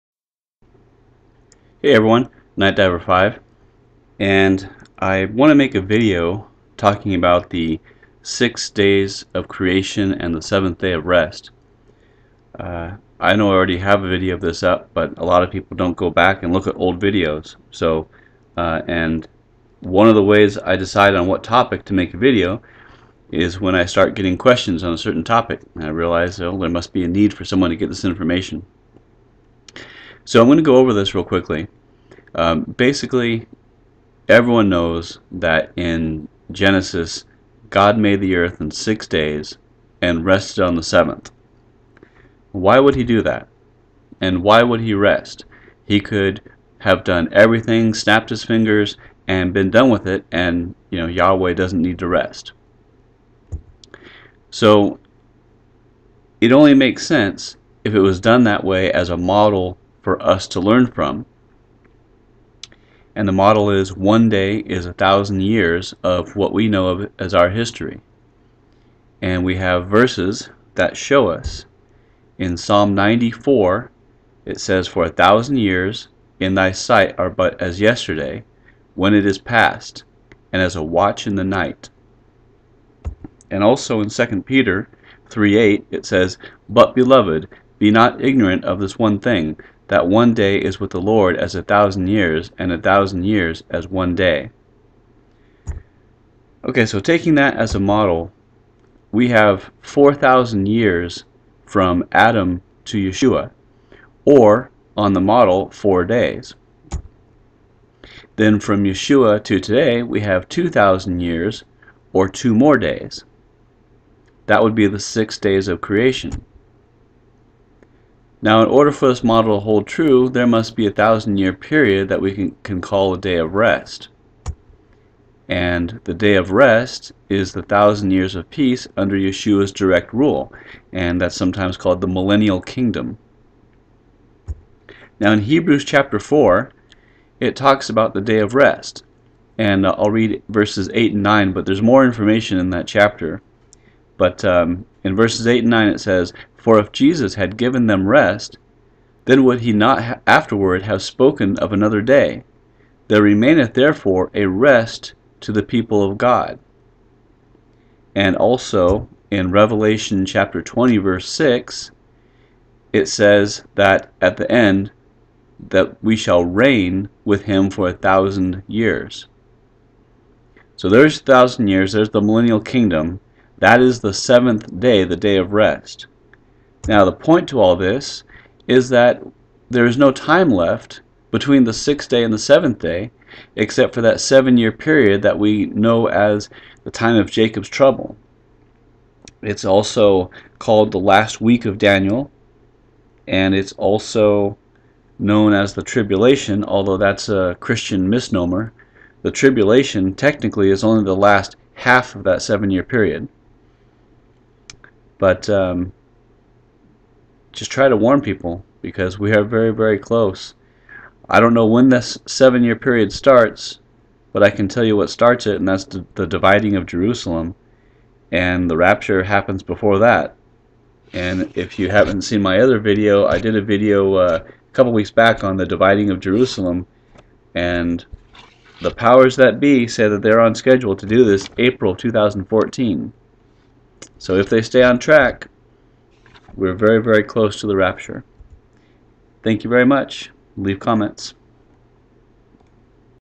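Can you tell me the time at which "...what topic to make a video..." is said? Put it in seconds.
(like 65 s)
21 s.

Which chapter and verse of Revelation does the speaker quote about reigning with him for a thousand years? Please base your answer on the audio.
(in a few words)
Revelation 20:6.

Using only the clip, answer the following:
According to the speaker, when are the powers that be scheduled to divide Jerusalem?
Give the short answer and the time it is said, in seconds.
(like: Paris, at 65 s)
April 2014, at 231 s.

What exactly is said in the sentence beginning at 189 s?
It's also called the last week of Daniel, and it's also known as the tribulation, although that's a Christian misnomer.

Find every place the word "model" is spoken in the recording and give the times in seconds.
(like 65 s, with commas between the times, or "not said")
59 s, 63 s, 97 s, 105 s, 119 s.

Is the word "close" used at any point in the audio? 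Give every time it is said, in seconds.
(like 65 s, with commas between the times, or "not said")
209 s, 237 s.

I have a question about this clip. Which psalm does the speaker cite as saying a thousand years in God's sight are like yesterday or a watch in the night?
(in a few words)
Psalm 94.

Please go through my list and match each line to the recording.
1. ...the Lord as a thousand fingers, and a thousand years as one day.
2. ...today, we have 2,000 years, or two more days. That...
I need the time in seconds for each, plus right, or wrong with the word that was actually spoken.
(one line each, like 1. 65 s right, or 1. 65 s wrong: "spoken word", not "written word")
1. 90 s wrong: "years", not "fingers"
2. 109 s right.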